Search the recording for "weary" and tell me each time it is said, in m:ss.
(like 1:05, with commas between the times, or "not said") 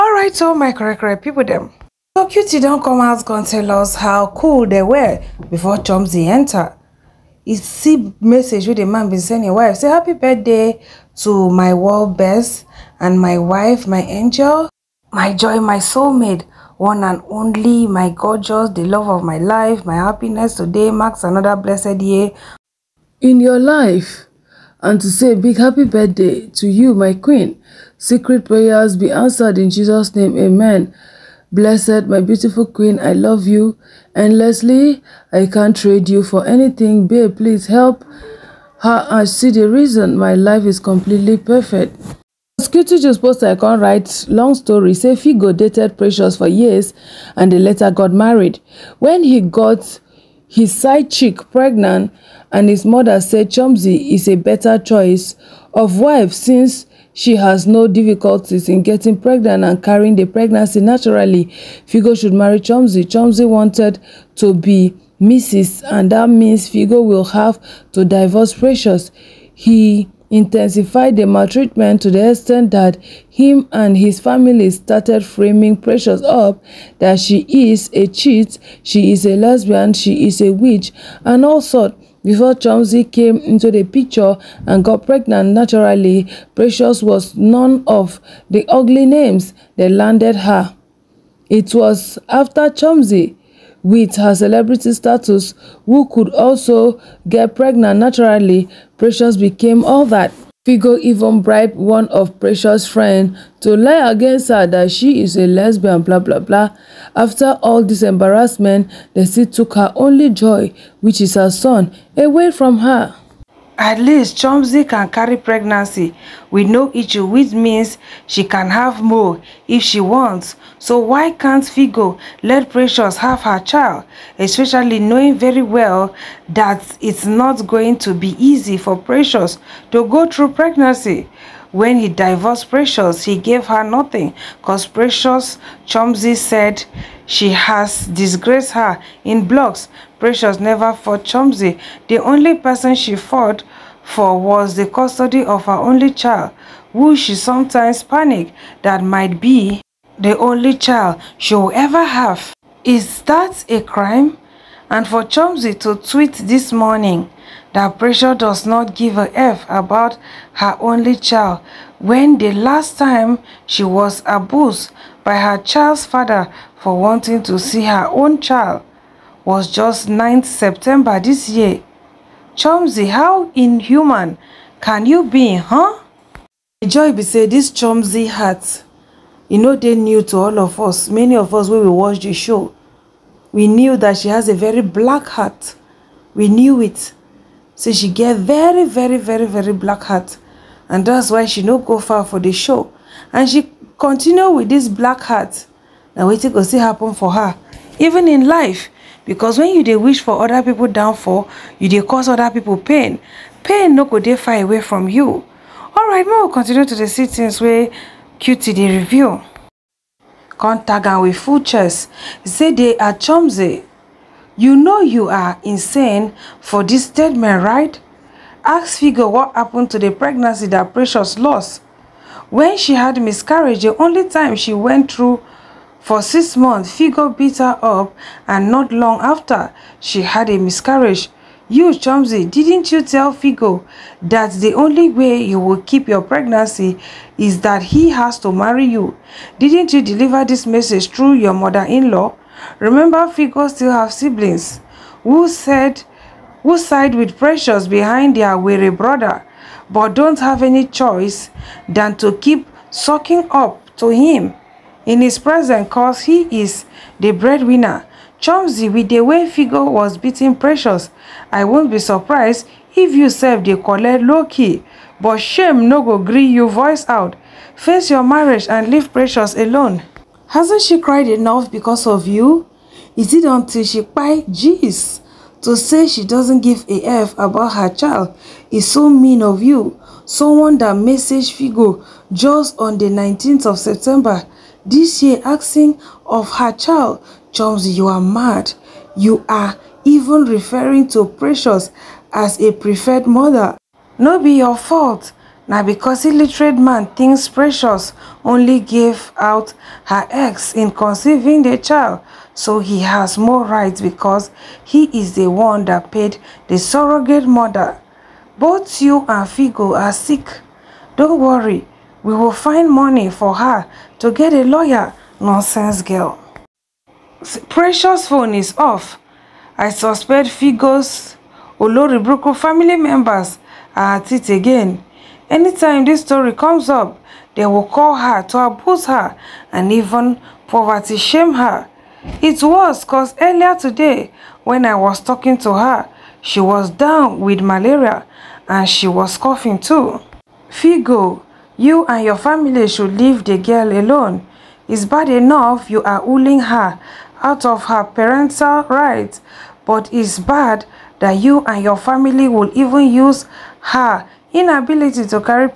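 4:08.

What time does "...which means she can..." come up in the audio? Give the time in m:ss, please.
1:57.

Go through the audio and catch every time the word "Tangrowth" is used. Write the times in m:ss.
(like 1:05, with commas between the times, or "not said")
not said.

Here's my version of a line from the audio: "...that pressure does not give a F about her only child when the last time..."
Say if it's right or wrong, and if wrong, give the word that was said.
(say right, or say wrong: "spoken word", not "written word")
right.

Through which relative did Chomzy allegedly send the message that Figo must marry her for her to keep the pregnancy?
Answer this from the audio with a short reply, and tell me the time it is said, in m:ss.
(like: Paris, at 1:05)
Mother-in-law, at 4:01.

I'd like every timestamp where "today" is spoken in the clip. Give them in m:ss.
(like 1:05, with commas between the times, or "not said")
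0:20, 5:33.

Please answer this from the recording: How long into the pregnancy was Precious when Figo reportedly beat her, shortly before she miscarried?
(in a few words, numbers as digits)
6 months.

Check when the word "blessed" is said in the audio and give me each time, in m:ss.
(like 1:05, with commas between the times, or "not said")
0:21, 0:31.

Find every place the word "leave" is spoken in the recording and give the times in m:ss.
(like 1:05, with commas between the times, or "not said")
4:28, 5:43.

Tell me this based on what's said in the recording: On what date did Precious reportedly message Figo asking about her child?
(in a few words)
19th September.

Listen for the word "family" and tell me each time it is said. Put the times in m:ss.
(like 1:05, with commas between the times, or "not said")
1:14, 5:22, 5:42, 5:51.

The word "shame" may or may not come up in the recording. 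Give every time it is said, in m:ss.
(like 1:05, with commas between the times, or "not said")
4:25, 5:31.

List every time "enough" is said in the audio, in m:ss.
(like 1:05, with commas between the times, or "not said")
4:31, 5:45.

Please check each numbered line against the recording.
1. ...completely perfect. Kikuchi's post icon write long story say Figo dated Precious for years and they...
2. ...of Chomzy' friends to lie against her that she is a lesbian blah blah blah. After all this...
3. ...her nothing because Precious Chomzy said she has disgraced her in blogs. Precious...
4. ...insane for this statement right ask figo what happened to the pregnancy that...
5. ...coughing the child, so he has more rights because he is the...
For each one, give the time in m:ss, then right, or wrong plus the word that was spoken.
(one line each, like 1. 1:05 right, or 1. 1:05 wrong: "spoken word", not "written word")
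1. 0:40 right
2. 1:42 wrong: "Precious", not "Chomzy"
3. 2:13 right
4. 3:35 right
5. 5:00 wrong: "conceiving", not "coughing".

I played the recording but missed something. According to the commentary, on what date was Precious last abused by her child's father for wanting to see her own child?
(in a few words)
9th September.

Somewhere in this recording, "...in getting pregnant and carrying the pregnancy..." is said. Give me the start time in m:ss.
0:58.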